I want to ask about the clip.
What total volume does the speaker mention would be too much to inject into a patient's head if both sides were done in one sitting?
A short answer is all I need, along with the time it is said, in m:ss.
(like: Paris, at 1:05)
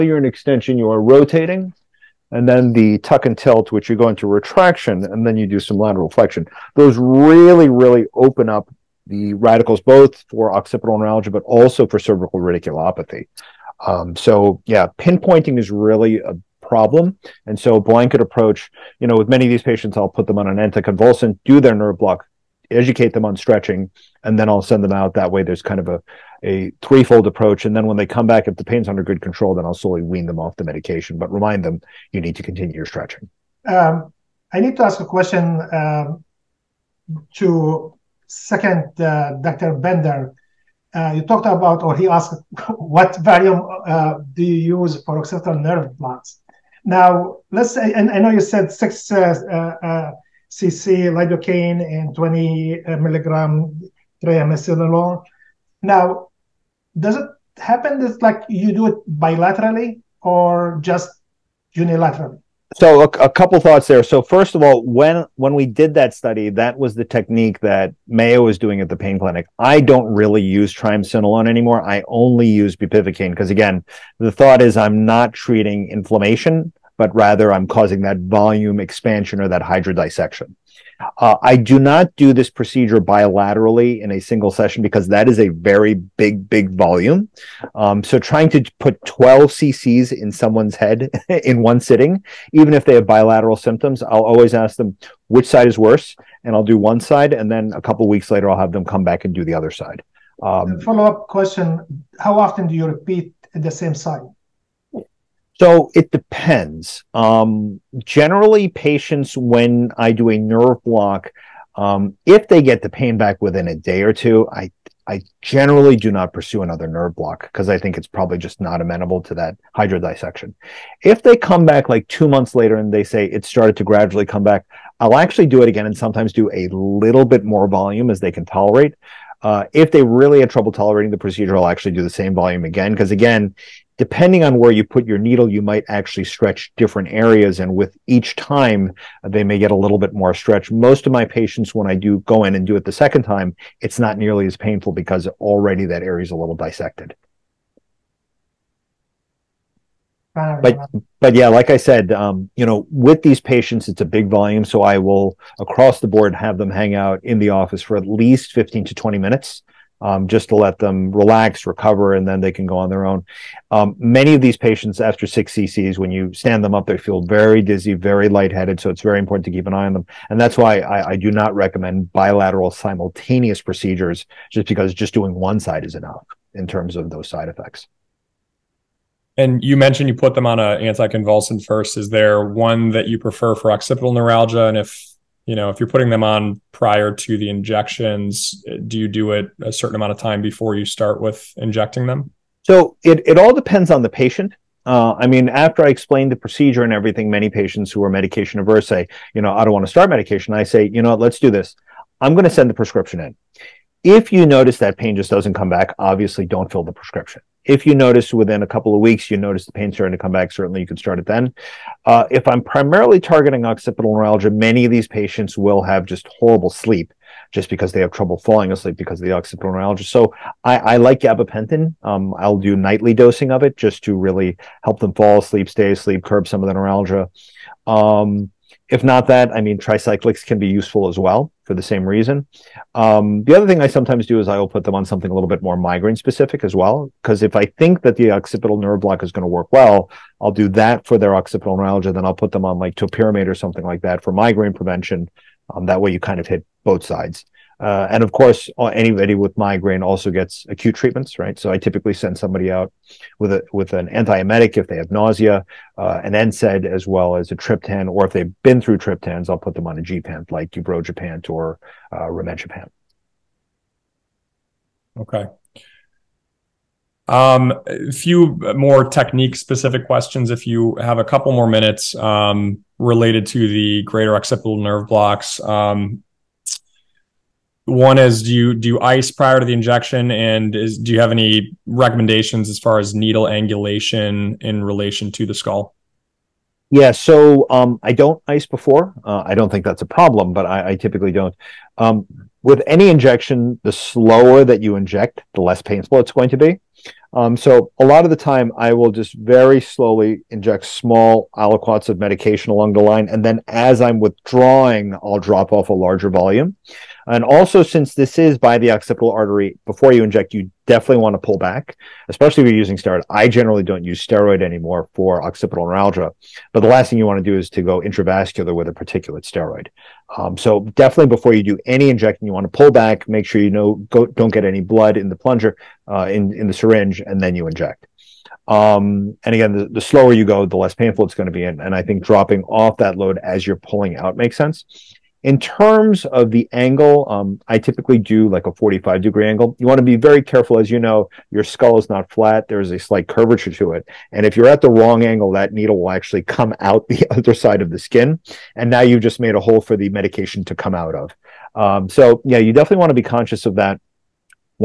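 12 cc, at 1:29.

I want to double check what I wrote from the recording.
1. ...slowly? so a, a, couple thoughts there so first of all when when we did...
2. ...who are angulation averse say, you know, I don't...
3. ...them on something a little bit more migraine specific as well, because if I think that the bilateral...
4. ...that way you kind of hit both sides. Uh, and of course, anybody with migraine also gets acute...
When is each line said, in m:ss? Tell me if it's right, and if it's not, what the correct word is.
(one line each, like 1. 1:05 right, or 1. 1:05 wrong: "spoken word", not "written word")
1. 1:01 wrong: "unilaterally", not "slowly"
2. 3:17 wrong: "medication", not "angulation"
3. 3:54 wrong: "occipital", not "bilateral"
4. 4:05 right.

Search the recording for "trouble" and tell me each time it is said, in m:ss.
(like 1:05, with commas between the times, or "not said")
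2:10, 3:38.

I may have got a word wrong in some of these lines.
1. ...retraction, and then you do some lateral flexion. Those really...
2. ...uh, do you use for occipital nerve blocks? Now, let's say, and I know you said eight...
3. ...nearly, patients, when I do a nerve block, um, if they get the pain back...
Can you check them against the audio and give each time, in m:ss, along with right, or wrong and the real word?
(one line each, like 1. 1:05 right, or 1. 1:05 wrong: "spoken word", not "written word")
1. 0:04 right
2. 0:43 wrong: "six", not "eight"
3. 1:48 wrong: "generally", not "nearly".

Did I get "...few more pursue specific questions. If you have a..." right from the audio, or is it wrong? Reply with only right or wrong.
wrong.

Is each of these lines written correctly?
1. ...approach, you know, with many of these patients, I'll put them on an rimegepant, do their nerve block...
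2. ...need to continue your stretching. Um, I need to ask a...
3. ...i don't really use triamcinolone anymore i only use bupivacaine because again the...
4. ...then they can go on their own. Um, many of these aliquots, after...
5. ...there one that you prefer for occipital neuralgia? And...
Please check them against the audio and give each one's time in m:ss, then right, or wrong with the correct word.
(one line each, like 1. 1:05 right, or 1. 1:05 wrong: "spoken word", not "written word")
1. 0:18 wrong: "anticonvulsant", not "rimegepant"
2. 0:32 right
3. 1:09 right
4. 2:42 wrong: "patients", not "aliquots"
5. 3:02 right.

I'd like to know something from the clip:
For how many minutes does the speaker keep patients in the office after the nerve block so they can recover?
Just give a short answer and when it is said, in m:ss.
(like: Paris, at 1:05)
15 to 20 minutes, at 2:38.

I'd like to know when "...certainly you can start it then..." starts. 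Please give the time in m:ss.
3:30.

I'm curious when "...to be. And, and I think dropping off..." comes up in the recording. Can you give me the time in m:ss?
5:31.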